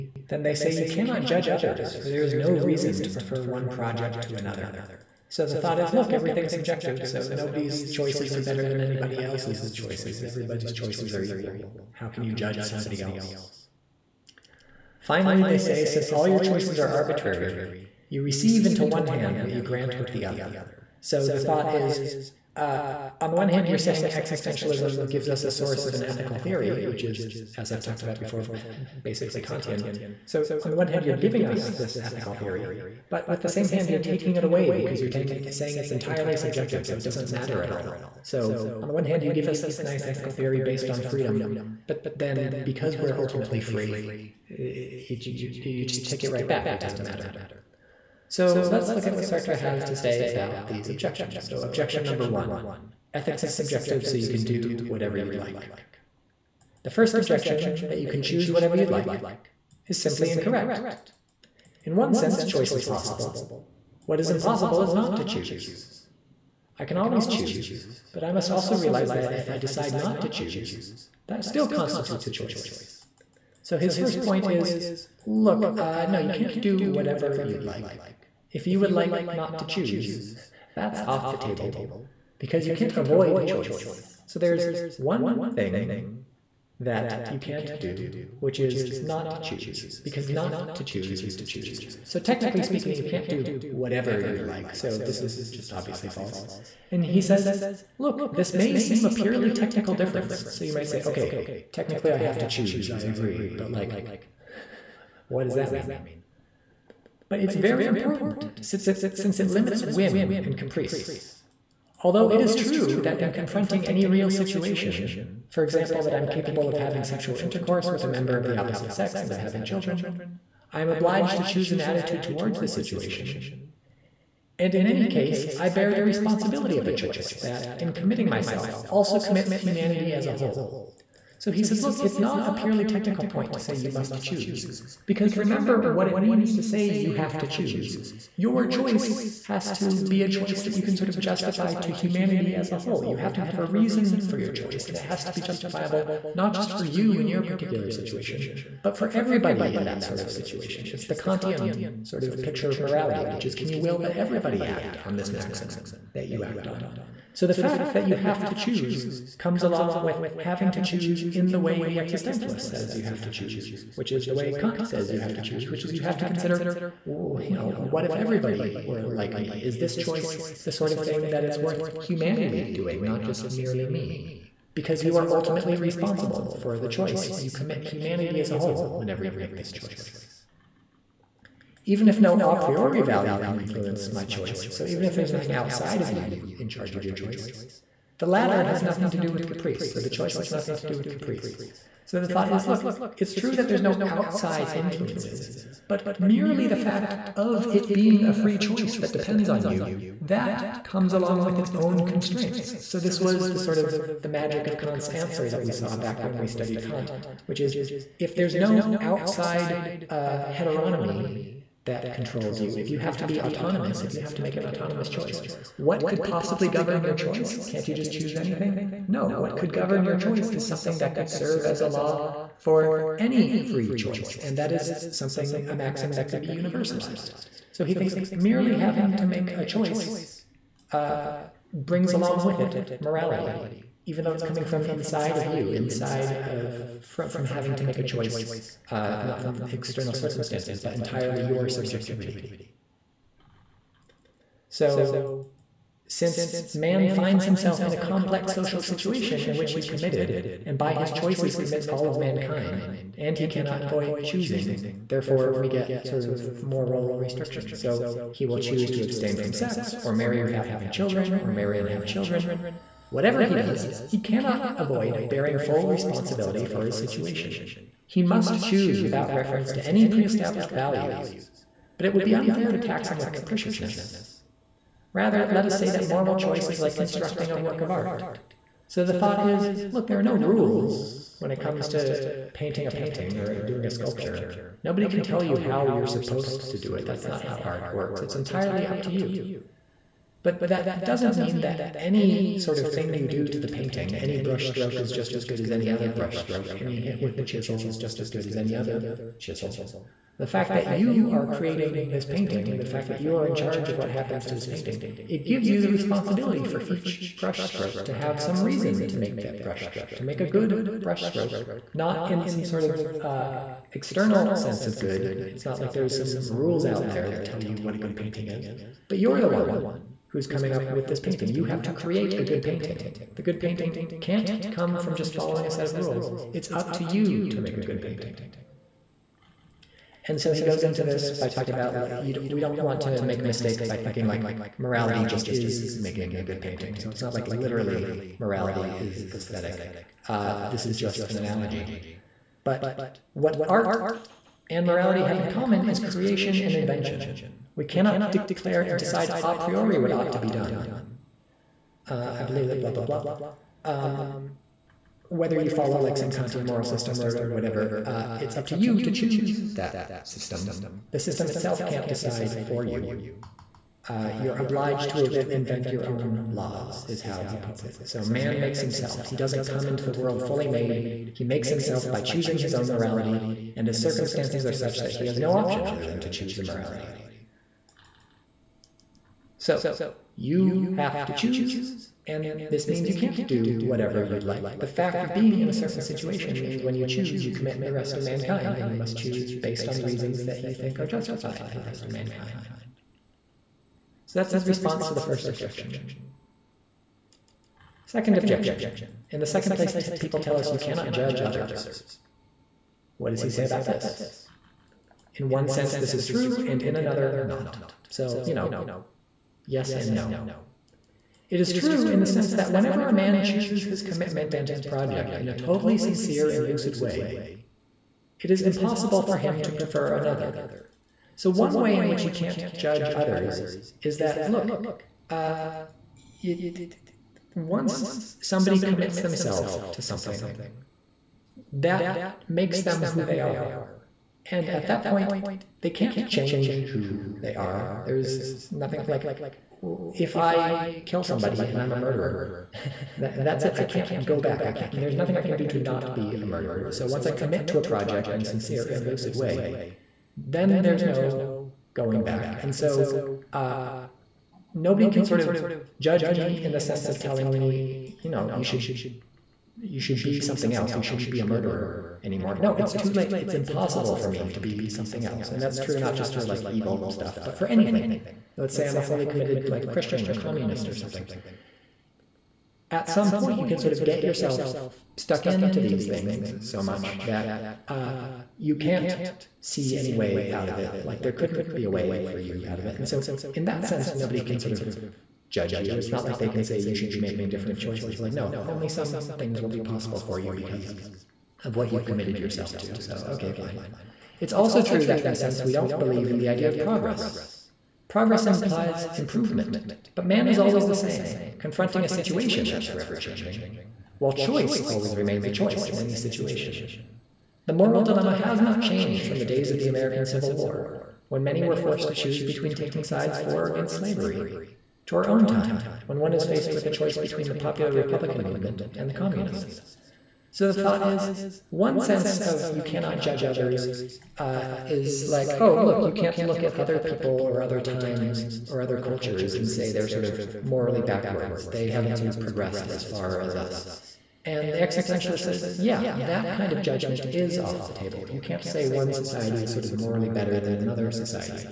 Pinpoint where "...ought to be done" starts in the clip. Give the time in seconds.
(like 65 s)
350 s.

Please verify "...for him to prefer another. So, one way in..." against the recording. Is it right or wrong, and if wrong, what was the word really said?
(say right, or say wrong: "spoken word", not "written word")
right.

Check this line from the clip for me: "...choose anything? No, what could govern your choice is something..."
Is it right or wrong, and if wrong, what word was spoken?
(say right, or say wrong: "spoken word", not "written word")
right.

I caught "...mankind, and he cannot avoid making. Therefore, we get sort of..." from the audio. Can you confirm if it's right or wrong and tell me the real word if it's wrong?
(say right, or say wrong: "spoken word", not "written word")
wrong: "choosing", not "making".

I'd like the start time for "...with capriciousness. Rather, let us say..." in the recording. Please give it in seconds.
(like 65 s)
273 s.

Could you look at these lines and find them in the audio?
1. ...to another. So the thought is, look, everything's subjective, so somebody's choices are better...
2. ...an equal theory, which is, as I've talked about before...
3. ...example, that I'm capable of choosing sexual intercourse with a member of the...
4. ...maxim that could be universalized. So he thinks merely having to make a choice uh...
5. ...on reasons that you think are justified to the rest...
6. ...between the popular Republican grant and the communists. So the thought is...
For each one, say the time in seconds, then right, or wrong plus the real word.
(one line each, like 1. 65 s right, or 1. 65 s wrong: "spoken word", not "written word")
1. 4 s wrong: "nobody", not "somebody"
2. 25 s wrong: "ethical", not "equal"
3. 115 s wrong: "having", not "choosing"
4. 225 s right
5. 389 s right
6. 517 s wrong: "movement", not "grant".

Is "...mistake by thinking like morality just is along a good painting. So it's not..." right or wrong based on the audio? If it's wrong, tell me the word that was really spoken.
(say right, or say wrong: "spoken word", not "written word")
wrong: "making", not "along".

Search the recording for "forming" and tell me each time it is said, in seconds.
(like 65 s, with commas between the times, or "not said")
not said.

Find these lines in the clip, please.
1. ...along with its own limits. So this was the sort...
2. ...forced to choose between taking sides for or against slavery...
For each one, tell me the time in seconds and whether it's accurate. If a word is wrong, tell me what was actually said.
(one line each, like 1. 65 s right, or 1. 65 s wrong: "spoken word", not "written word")
1. 201 s wrong: "constraints", not "limits"
2. 511 s right.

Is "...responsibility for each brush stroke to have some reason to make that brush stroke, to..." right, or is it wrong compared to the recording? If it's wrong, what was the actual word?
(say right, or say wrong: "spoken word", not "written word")
right.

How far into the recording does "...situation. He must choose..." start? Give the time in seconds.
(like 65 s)
266 s.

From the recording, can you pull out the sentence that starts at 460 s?
You shouldn't be a murderer anymore.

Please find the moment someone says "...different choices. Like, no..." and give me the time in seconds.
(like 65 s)
487 s.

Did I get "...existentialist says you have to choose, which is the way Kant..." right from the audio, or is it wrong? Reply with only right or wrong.
right.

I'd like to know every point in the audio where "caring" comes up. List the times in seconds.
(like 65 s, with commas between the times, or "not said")
not said.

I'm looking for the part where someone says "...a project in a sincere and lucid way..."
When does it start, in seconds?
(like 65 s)
447 s.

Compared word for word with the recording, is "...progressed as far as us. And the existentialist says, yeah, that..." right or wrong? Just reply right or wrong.
right.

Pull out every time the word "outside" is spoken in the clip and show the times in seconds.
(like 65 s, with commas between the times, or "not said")
185 s, 194 s, 208 s.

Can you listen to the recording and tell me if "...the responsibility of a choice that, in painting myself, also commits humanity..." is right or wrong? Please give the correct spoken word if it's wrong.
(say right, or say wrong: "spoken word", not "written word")
wrong: "committing", not "painting".